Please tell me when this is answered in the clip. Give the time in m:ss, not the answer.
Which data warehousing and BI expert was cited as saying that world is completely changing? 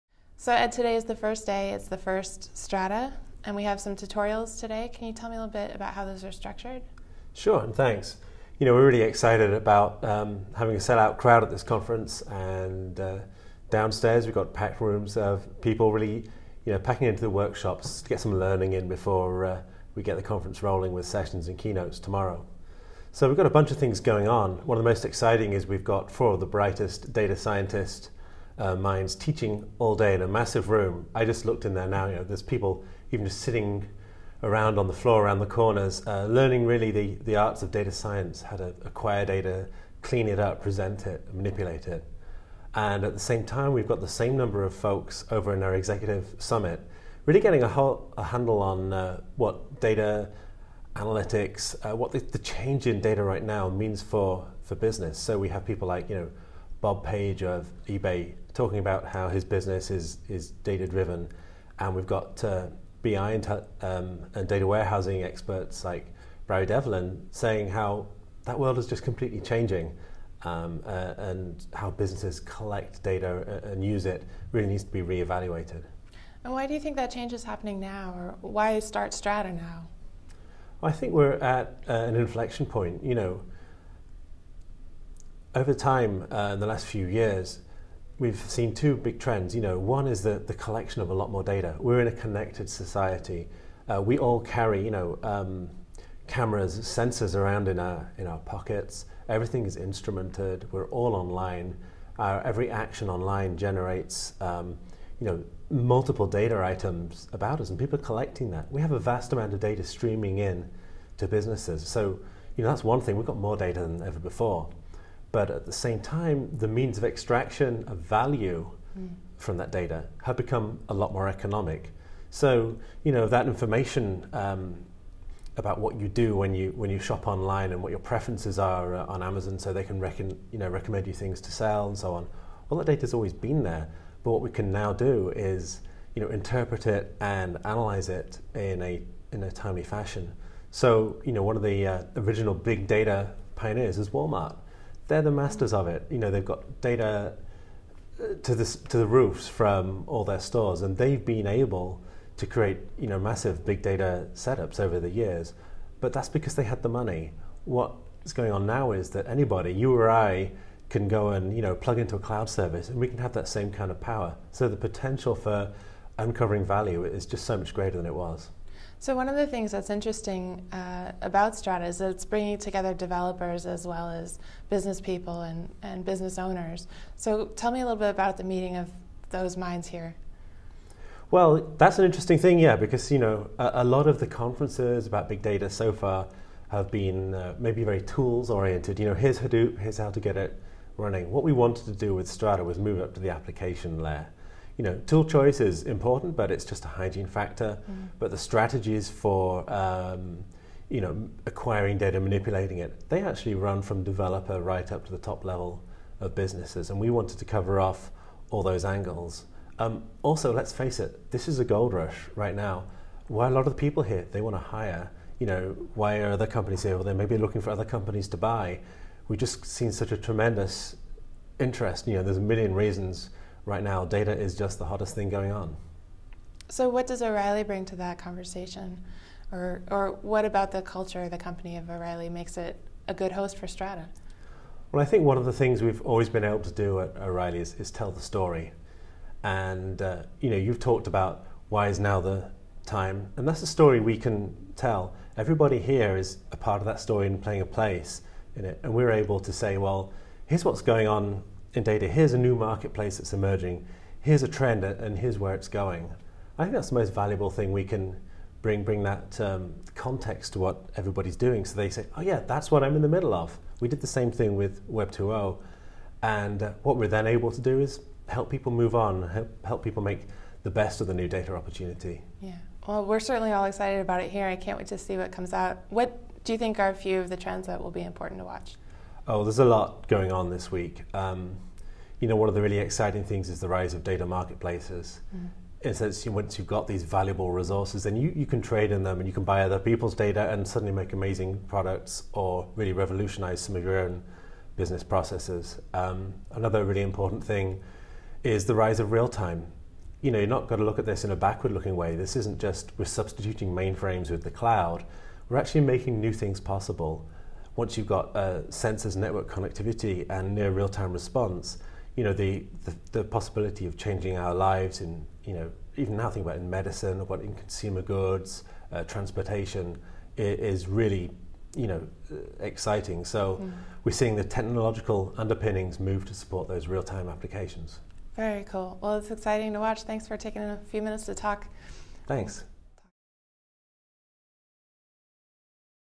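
1:06.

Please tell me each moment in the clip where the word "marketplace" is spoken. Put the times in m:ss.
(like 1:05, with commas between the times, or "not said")
4:12, 4:44.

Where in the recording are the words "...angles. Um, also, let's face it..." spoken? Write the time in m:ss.
3:28.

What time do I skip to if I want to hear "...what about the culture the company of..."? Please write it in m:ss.
3:50.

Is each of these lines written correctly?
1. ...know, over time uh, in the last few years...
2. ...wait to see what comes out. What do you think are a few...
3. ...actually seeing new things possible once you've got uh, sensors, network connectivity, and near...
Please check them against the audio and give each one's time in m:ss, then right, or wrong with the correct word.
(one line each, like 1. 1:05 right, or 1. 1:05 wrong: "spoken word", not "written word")
1. 1:23 right
2. 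4:34 right
3. 5:05 wrong: "making", not "seeing".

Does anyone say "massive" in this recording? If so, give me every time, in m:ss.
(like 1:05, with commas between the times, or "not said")
0:30, 2:33.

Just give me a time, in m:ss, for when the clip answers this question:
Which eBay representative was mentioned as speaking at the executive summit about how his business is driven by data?
0:56.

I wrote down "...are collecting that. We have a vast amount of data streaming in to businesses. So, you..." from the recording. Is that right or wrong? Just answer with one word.
right.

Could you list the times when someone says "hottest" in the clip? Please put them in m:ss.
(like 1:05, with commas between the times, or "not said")
3:44.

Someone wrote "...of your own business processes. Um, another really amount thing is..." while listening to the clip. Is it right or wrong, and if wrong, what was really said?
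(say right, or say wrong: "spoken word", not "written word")
wrong: "important", not "amount".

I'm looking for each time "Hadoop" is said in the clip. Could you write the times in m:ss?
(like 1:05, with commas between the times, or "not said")
3:09.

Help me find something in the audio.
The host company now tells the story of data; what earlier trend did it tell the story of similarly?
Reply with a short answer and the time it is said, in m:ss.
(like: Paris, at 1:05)
Web 2.0, at 4:24.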